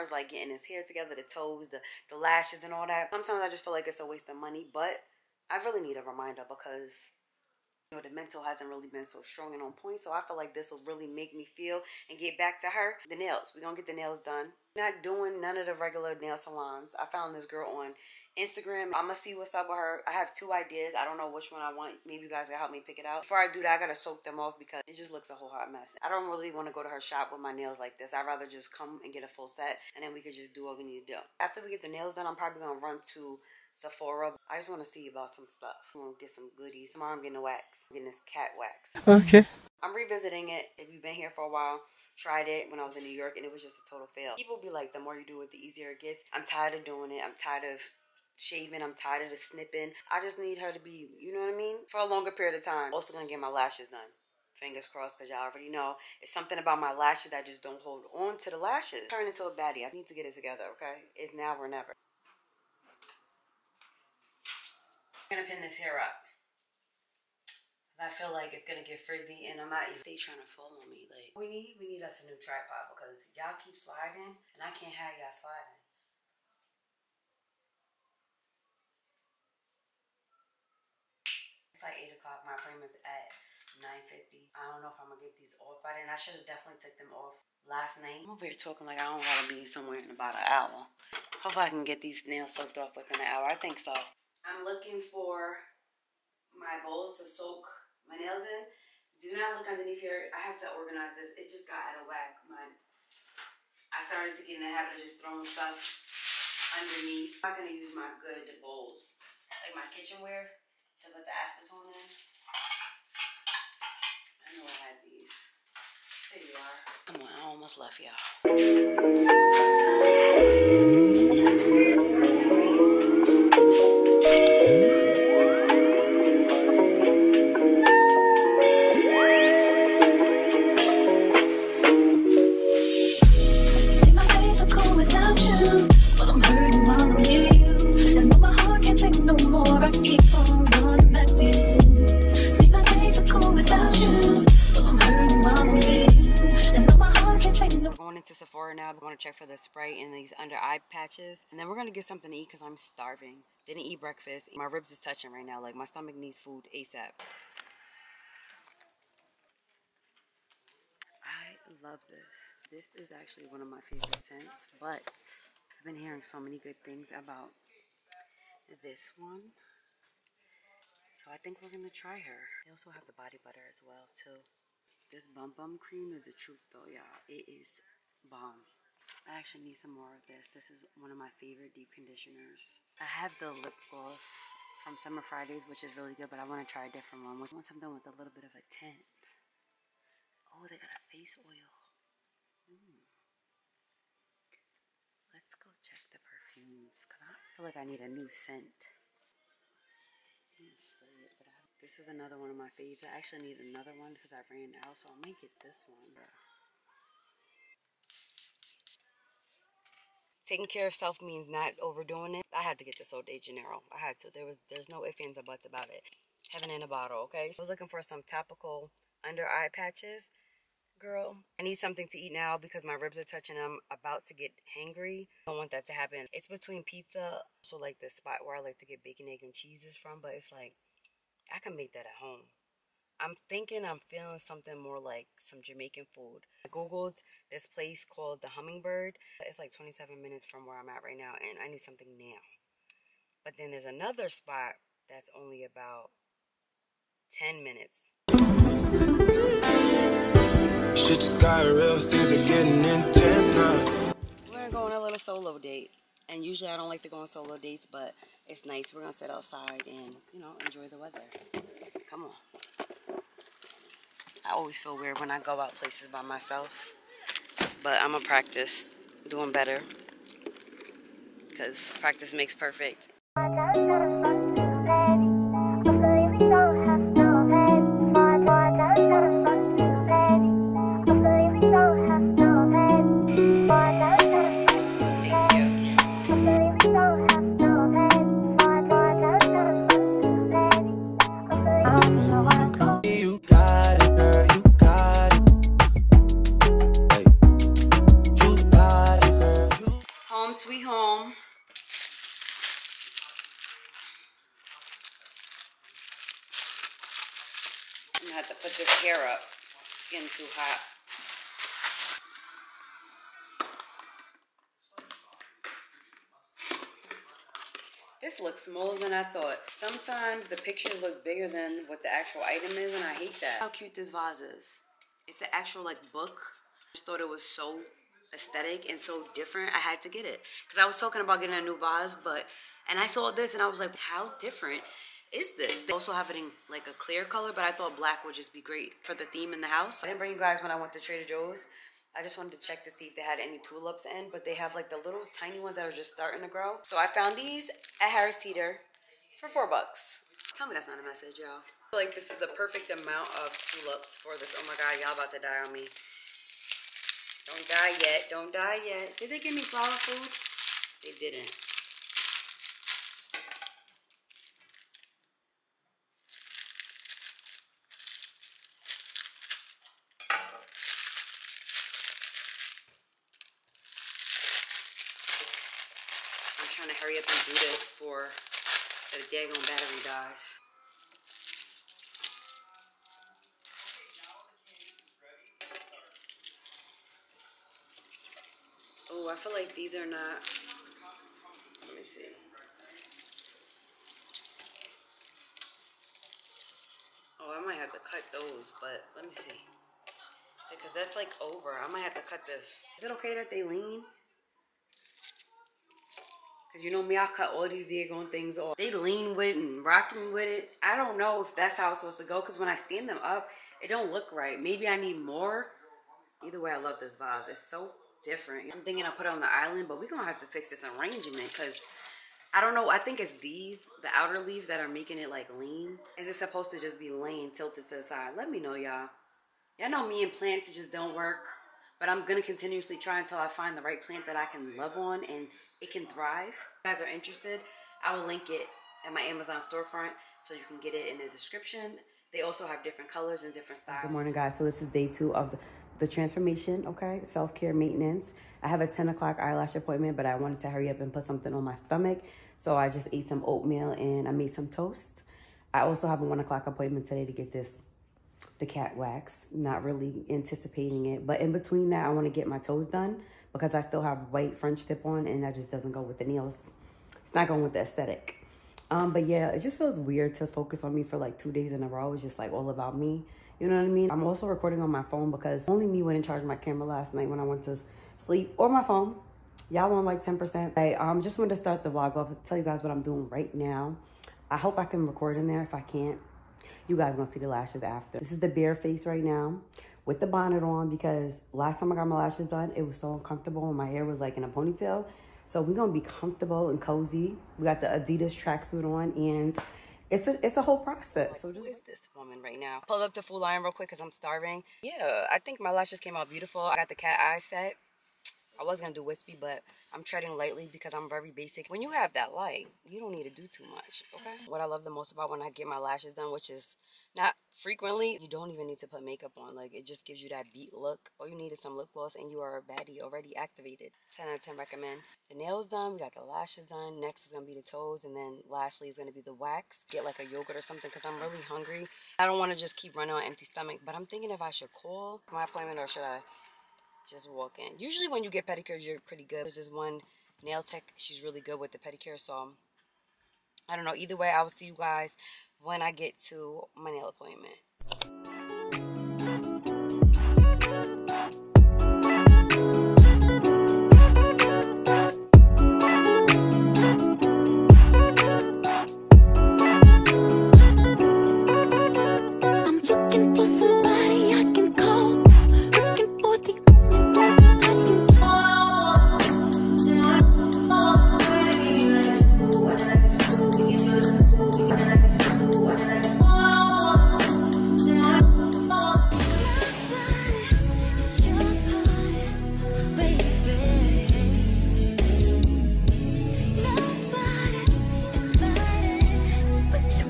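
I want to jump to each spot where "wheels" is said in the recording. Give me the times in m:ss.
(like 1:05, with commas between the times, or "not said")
not said.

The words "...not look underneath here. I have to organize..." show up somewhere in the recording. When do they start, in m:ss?
1:39.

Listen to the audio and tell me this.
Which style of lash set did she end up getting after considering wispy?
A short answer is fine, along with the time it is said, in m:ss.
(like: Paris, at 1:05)
Cat eye set, at 8:26.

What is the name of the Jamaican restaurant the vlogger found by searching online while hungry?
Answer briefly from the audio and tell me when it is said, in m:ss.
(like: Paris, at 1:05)
The Hummingbird, at 3:58.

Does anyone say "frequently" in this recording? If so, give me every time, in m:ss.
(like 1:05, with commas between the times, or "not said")
8:37.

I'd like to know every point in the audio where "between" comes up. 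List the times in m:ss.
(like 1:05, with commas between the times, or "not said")
3:46, 7:41.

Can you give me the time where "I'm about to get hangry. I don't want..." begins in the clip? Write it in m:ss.
3:43.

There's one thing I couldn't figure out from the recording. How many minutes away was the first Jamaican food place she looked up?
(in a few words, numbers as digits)
27.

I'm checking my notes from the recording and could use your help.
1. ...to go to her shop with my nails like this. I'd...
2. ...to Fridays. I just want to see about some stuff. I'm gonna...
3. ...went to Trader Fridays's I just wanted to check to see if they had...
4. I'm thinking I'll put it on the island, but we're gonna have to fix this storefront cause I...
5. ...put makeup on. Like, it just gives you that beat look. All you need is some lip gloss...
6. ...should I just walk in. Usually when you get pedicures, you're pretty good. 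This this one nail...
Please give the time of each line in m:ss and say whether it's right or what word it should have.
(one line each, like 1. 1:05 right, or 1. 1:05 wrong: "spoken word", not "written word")
1. 0:26 right
2. 0:33 wrong: "Sephora", not "Fridays"
3. 5:40 wrong: "Joe", not "Fridays"
4. 6:58 wrong: "arrangement", not "storefront"
5. 8:38 right
6. 8:55 right.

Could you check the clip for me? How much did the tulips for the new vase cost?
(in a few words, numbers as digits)
4 dollars.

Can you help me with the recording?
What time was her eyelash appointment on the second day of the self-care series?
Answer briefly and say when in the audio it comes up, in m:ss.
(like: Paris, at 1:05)
10 o'clock, at 7:28.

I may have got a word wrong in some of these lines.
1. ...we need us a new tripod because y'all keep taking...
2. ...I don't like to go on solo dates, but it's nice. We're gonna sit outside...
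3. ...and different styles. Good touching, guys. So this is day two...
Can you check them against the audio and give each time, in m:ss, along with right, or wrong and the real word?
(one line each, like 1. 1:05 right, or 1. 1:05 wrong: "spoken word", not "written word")
1. 1:11 wrong: "sliding", not "taking"
2. 4:16 right
3. 7:23 wrong: "morning", not "touching".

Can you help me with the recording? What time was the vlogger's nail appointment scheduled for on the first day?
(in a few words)
9:50.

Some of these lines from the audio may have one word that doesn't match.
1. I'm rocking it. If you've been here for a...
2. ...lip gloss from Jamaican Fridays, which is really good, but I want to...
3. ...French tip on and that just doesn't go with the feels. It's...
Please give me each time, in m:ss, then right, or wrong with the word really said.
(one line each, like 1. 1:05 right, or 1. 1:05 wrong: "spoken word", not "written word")
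1. 0:39 wrong: "revisiting", not "rocking"
2. 3:03 wrong: "Summer", not "Jamaican"
3. 7:44 wrong: "nails", not "feels".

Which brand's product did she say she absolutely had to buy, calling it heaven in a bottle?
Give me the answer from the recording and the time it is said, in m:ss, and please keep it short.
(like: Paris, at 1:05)
Sol de Janeiro, at 3:33.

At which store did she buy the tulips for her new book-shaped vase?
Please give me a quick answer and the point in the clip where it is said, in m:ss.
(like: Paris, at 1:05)
Harris Teeter, at 5:48.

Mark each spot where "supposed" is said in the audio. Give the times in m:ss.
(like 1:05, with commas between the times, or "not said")
6:51, 7:06.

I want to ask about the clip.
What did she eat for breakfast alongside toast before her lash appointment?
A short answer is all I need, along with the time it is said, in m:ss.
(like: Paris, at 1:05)
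Oatmeal, at 7:33.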